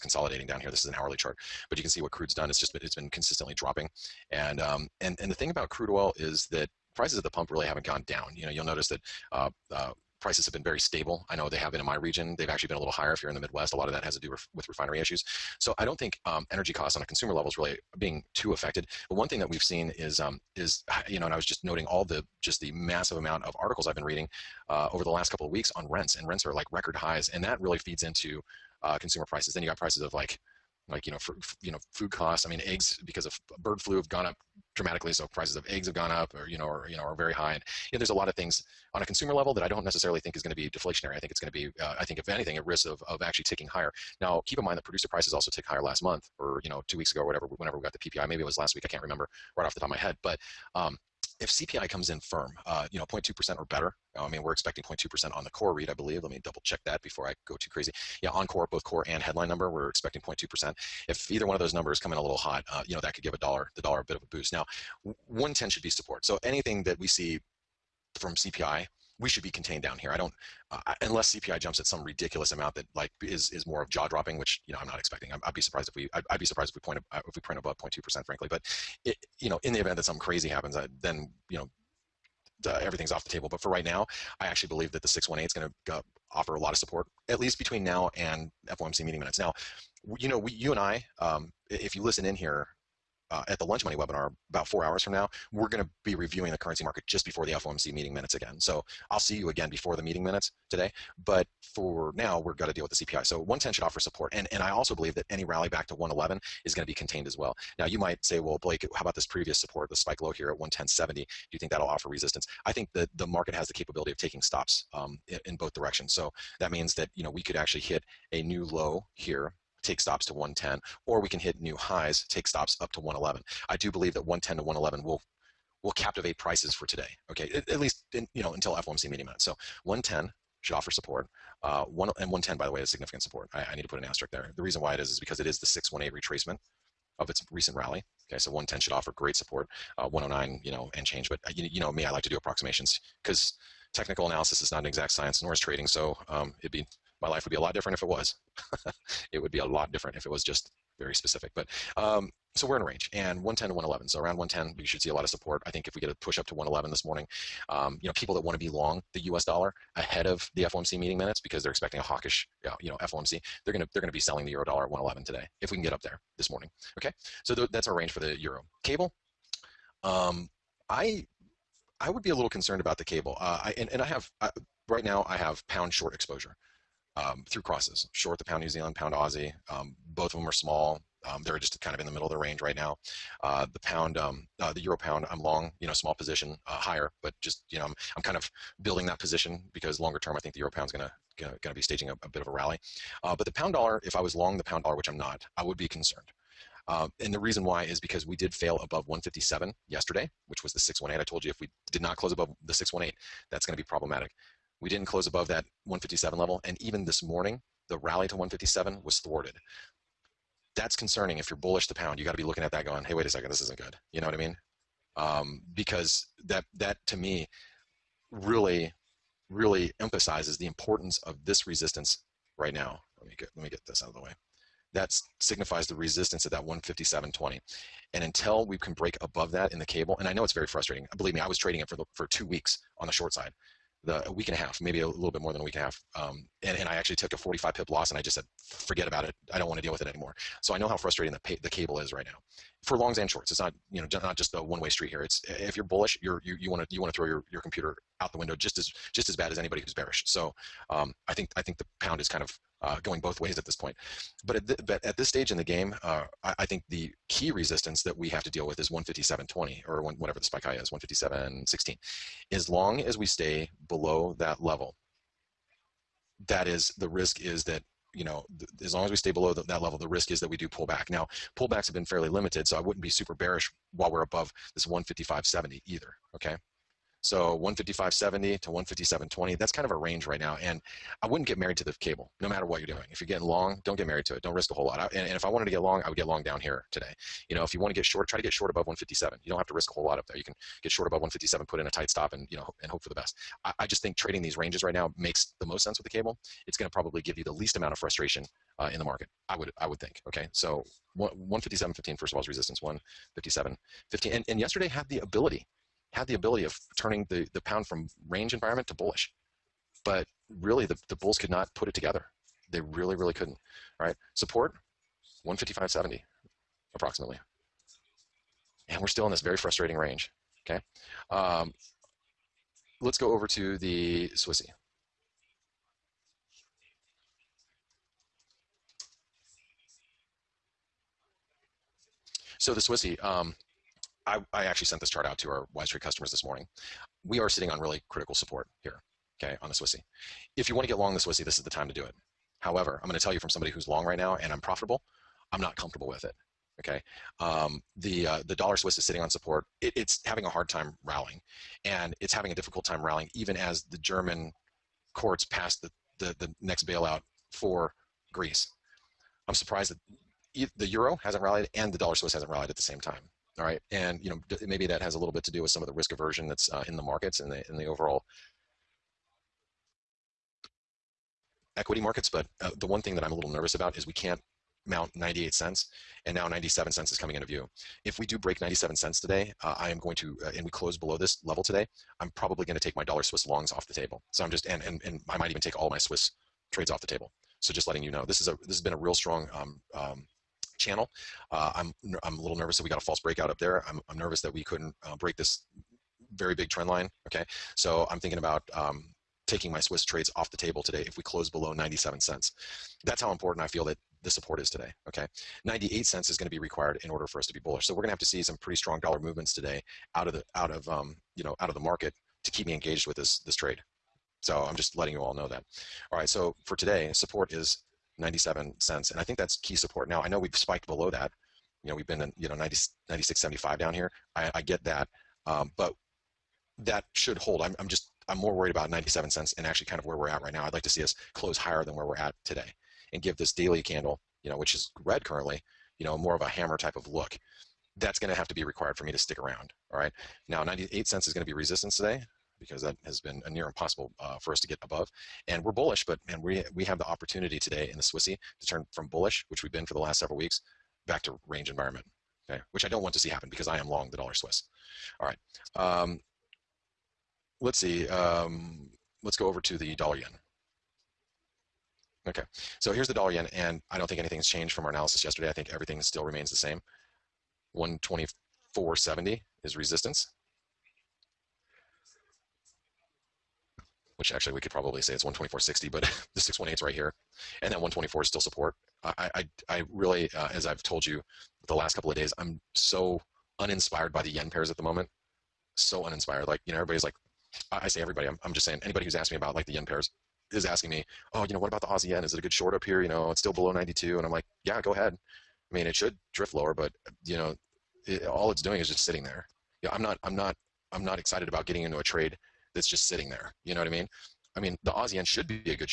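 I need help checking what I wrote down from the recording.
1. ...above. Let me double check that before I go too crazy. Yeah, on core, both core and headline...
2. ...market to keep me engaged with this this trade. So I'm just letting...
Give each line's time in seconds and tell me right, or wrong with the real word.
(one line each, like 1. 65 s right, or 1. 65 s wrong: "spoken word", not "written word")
1. 55 s wrong: "believe", not "above"
2. 411 s right.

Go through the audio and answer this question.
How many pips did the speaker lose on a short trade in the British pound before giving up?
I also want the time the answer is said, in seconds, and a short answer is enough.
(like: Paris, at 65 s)
45 pips, at 237 s.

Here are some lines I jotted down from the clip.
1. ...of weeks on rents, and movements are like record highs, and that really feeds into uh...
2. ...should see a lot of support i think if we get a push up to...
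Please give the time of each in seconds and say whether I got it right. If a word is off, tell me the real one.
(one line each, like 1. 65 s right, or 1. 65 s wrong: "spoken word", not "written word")
1. 25 s wrong: "rents", not "movements"
2. 154 s right.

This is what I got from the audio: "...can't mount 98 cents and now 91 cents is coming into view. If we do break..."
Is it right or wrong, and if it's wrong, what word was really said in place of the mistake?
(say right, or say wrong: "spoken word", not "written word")
wrong: "97", not "91".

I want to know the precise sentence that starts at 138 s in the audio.
Okay, so 110 should offer great support, uh, 109, you know, and change.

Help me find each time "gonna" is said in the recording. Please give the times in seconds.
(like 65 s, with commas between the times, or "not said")
191 s.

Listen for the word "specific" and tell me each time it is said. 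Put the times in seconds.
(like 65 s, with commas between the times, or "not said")
151 s.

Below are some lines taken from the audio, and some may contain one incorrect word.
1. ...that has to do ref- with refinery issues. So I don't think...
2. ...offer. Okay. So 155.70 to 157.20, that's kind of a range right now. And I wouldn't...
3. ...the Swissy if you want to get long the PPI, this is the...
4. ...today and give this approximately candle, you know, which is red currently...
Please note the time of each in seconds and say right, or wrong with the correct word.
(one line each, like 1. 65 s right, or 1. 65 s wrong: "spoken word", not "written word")
1. 13 s right
2. 275 s wrong: "either", not "offer"
3. 339 s wrong: "Swissy", not "PPI"
4. 432 s wrong: "daily", not "approximately".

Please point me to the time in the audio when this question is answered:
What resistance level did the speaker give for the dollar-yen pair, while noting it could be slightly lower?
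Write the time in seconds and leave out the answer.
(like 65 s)
467 s.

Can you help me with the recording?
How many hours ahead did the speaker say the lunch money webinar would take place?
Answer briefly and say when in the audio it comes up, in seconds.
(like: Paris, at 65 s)
four hours, at 94 s.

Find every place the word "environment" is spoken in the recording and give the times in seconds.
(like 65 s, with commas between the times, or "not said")
308 s, 451 s.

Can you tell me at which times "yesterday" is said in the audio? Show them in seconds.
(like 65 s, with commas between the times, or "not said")
199 s, 304 s, 465 s.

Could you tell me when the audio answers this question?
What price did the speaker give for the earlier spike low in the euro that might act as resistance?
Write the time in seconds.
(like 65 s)
110 s.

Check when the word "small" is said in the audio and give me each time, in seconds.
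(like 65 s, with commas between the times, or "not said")
180 s, 185 s.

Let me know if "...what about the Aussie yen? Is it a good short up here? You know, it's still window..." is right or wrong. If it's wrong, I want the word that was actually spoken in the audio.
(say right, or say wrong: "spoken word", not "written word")
wrong: "below", not "window".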